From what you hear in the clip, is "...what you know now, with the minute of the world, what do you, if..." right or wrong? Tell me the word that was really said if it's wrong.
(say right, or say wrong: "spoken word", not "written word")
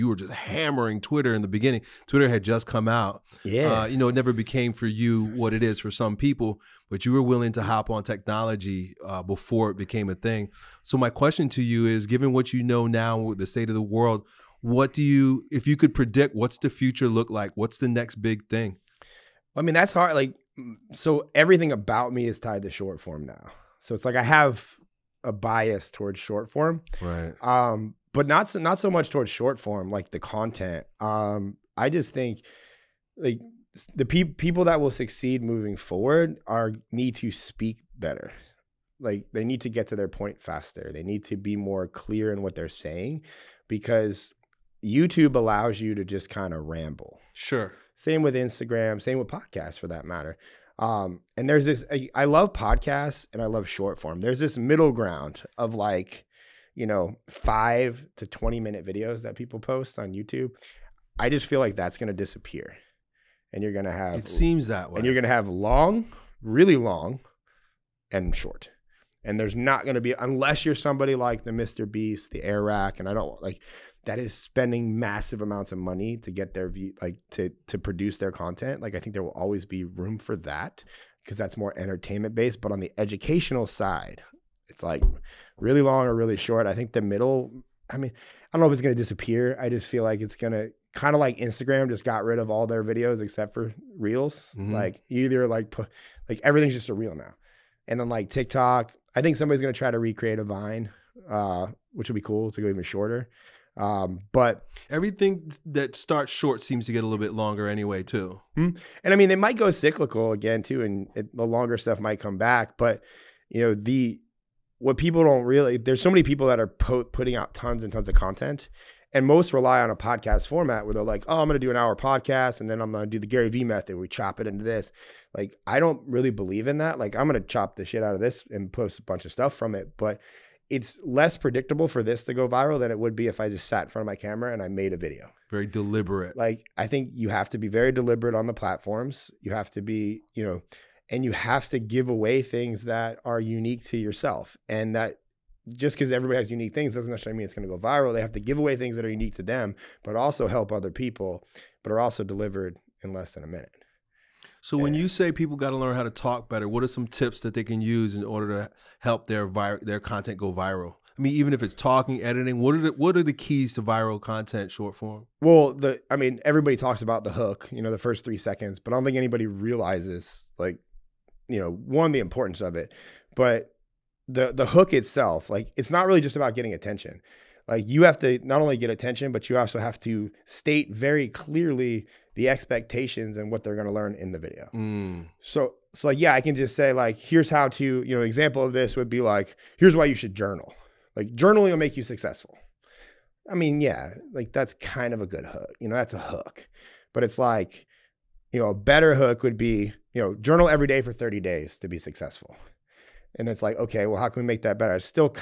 wrong: "state", not "minute".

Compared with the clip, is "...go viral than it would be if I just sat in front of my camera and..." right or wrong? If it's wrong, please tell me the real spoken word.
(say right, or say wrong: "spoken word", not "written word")
right.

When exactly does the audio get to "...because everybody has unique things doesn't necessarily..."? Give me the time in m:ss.
2:25.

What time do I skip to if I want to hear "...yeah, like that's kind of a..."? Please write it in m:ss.
3:13.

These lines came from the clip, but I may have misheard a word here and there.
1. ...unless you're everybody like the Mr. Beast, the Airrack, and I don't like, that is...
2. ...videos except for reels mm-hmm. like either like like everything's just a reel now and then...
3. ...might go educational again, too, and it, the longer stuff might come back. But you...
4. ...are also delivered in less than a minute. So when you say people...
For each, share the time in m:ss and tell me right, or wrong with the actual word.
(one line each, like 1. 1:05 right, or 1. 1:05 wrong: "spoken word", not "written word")
1. 1:10 wrong: "somebody", not "everybody"
2. 1:32 right
3. 1:49 wrong: "cyclical", not "educational"
4. 2:31 right.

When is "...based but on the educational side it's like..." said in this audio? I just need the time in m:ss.
1:22.